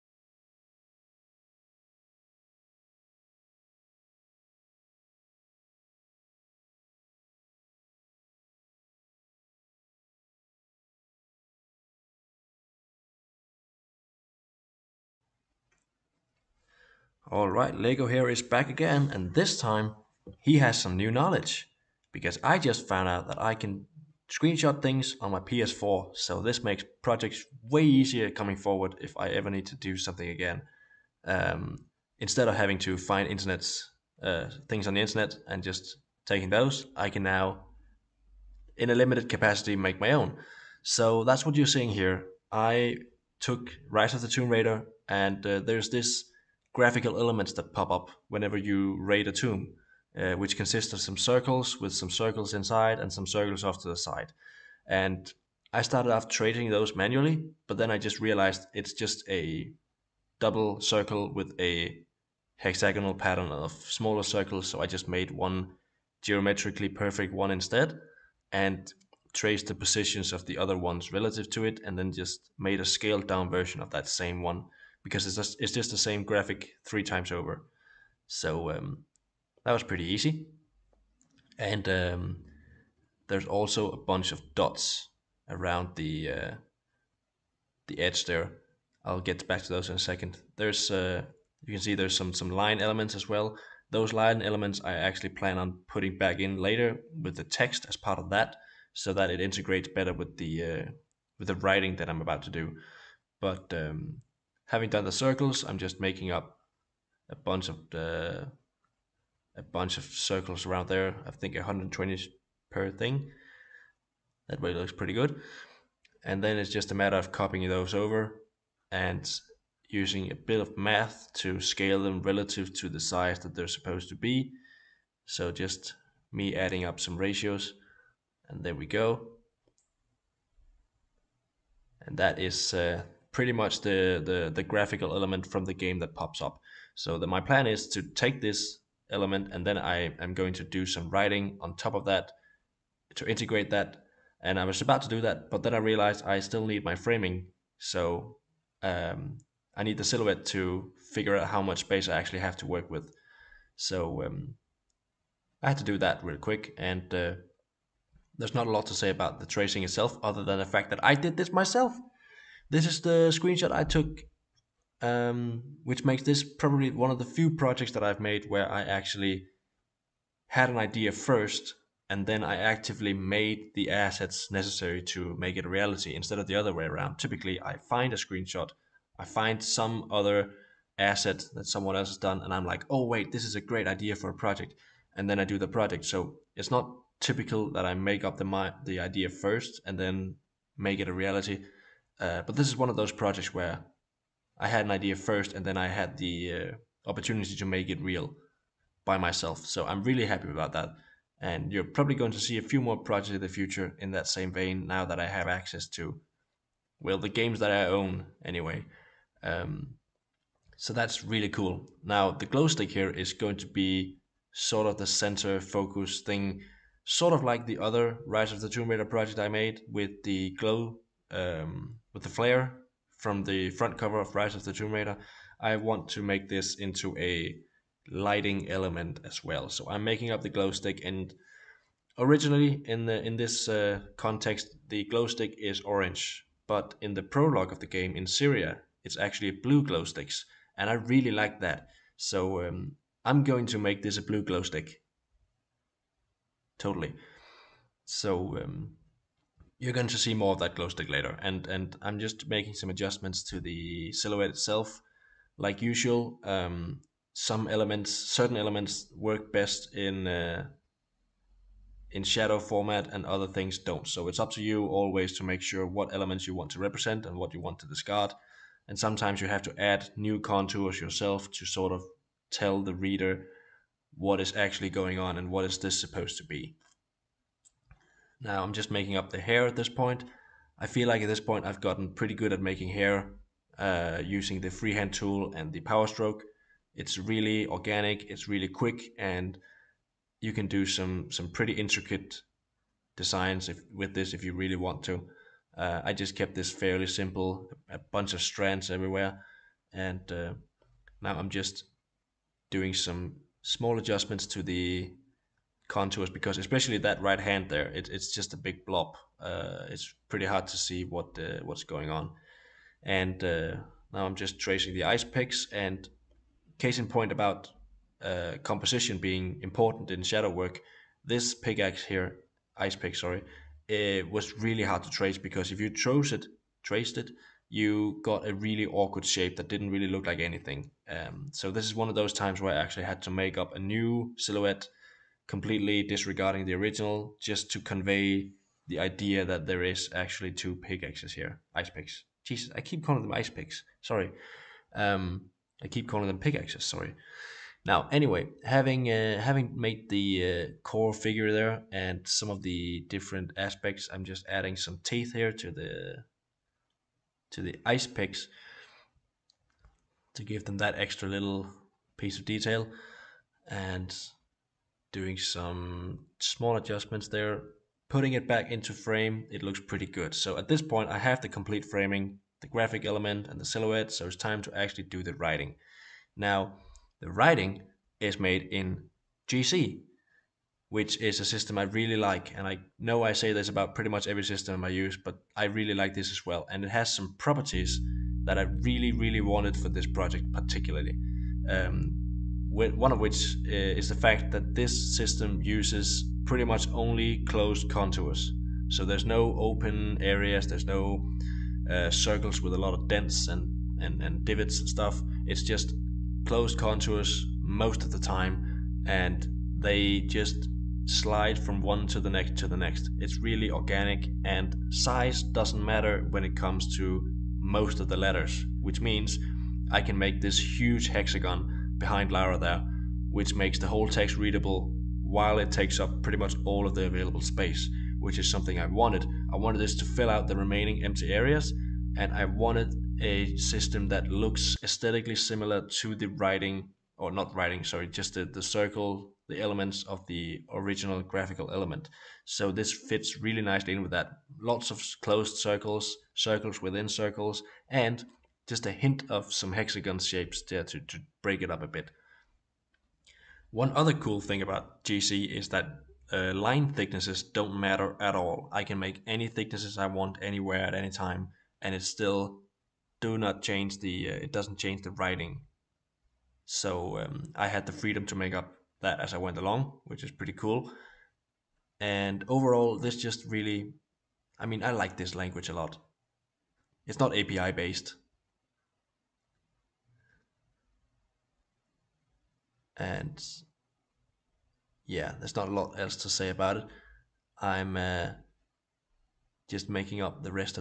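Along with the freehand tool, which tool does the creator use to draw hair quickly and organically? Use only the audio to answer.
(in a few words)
power stroke.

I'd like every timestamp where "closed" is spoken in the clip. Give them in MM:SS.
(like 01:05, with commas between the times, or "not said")
06:37, 06:46, 07:25.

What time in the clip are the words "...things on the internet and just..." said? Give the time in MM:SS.
00:34.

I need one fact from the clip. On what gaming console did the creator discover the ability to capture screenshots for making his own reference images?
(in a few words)
PS4.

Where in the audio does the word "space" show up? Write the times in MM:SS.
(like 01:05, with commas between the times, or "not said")
02:31, 07:07.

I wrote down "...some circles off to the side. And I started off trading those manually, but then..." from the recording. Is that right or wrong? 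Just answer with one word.
right.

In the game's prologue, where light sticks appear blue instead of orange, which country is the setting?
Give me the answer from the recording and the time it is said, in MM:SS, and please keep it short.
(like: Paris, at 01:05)
Syria, at 03:58.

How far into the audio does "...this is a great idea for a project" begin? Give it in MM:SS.
03:03.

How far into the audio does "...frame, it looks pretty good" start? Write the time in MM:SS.
06:08.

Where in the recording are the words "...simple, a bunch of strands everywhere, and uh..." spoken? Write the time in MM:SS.
04:57.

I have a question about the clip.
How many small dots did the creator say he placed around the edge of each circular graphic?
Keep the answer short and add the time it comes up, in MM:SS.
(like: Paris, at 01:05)
120, at 01:51.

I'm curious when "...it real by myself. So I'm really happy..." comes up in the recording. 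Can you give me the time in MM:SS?
03:17.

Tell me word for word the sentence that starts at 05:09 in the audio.
Uh, it's pretty hard to see what uh, what's going on.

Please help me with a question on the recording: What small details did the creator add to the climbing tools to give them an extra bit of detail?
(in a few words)
teeth.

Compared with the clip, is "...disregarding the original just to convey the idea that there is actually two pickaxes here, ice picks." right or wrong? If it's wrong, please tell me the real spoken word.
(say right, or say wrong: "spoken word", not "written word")
right.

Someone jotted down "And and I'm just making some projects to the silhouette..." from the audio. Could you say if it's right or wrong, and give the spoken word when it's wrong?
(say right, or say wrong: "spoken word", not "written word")
wrong: "adjustments", not "projects".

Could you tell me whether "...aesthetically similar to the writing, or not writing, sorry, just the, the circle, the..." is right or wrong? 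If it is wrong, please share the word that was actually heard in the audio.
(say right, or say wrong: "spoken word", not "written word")
right.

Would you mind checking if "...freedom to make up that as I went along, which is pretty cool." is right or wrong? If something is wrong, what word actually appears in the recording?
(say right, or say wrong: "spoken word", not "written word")
right.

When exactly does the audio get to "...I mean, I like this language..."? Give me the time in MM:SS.
07:54.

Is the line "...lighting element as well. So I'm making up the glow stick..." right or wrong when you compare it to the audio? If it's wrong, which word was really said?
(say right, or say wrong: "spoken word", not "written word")
right.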